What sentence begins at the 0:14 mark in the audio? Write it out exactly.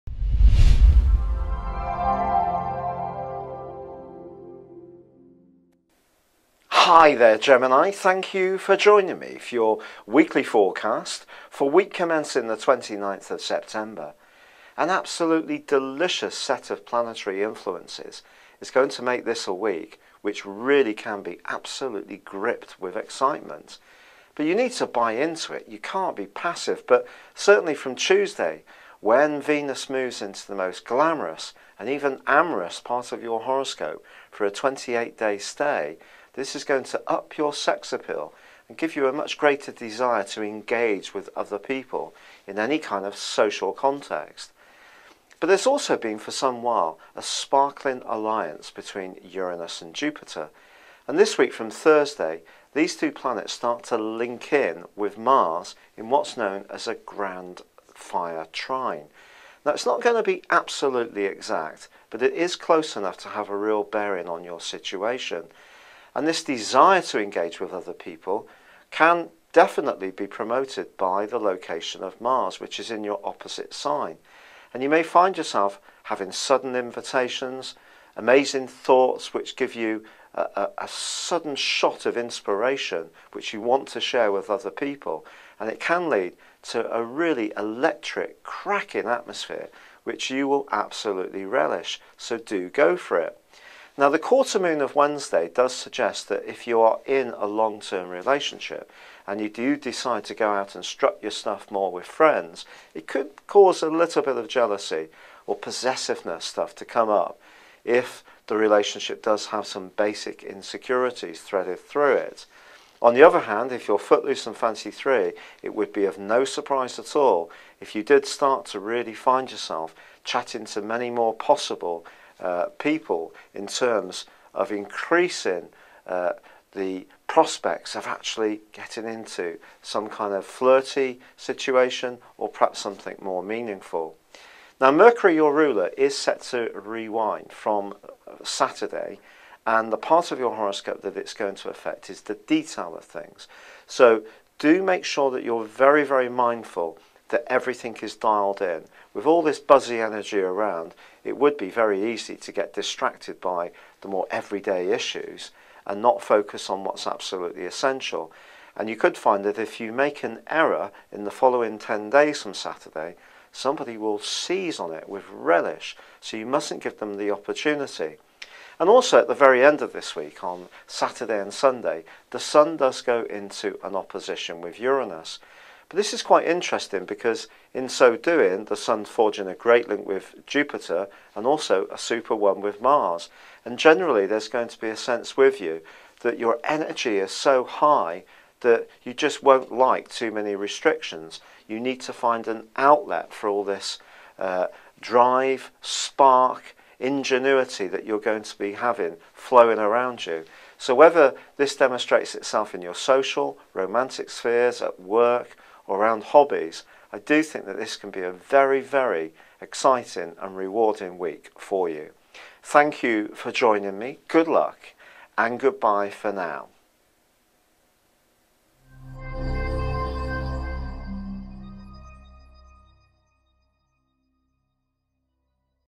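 An absolutely delicious set of planetary influences is going to make this a week which really can be absolutely gripped with excitement.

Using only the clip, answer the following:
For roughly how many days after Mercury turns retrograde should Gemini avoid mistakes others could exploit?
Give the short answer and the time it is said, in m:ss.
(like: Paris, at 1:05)
10, at 2:41.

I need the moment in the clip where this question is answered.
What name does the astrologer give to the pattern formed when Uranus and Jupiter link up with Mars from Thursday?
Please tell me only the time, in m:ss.
0:56.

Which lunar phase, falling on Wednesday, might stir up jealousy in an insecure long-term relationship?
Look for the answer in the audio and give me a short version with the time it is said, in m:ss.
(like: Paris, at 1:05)
quarter moon, at 1:34.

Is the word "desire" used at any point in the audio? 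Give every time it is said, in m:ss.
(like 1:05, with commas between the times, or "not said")
0:39, 1:06.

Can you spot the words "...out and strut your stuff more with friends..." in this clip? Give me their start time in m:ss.
1:40.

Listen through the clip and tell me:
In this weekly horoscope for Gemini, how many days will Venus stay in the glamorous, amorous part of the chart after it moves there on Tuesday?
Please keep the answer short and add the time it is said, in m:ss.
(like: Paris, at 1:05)
28, at 0:34.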